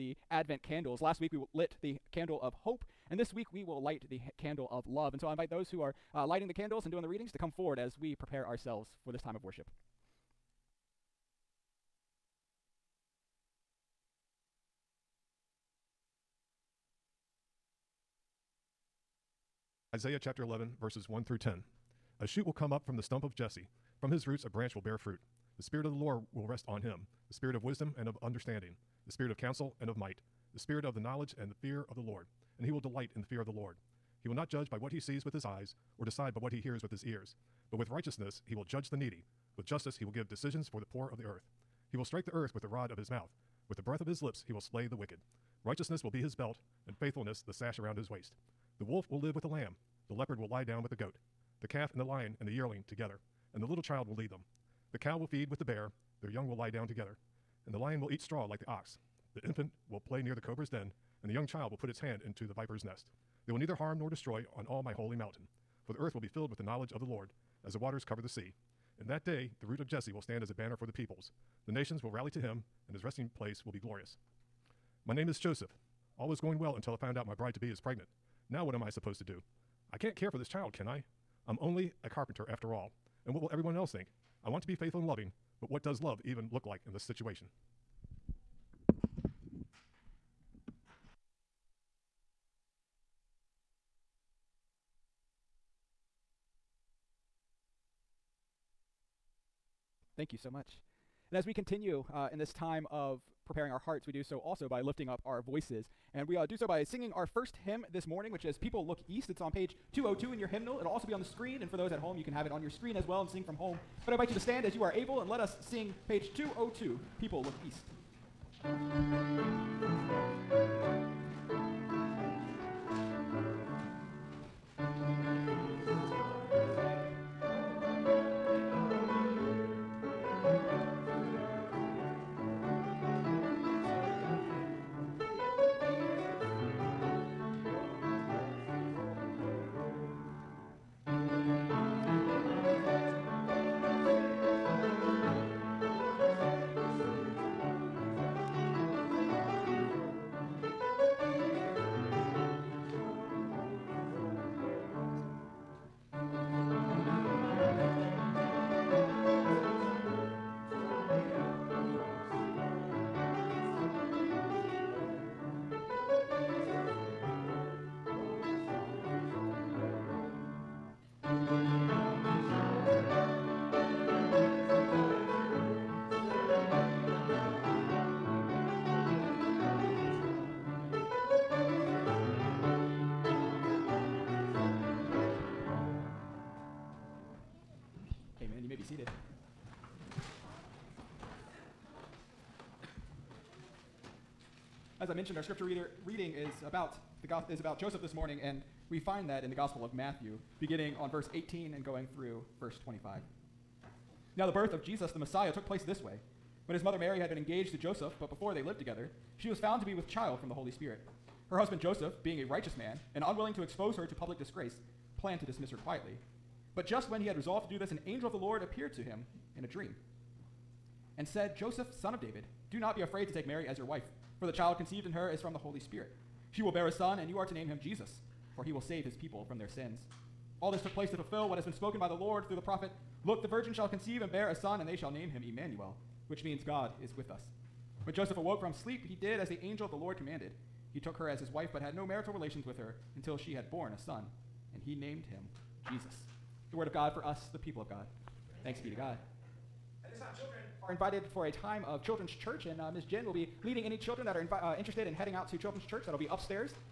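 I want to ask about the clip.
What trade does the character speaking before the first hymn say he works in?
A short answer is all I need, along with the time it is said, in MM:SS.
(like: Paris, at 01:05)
Carpenter, at 01:22.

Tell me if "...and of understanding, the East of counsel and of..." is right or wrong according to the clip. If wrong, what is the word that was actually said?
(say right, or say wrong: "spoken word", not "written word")
wrong: "Spirit", not "East".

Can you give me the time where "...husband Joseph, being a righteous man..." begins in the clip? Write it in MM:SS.
03:31.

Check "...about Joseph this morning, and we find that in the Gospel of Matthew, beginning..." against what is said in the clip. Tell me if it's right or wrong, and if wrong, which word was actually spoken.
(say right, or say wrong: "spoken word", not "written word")
right.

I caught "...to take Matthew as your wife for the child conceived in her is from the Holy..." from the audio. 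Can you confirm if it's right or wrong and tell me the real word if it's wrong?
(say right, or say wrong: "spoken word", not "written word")
wrong: "Mary", not "Matthew".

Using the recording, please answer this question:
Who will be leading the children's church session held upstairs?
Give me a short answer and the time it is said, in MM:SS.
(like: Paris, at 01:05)
Ms. Jen, at 04:12.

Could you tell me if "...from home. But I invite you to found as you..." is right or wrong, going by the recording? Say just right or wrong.
wrong.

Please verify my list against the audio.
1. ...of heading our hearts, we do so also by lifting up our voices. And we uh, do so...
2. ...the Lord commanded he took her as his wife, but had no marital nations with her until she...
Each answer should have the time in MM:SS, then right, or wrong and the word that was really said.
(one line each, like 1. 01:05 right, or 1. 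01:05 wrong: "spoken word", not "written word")
1. 01:42 wrong: "preparing", not "heading"
2. 03:59 wrong: "relations", not "nations".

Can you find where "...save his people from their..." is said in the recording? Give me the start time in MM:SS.
03:48.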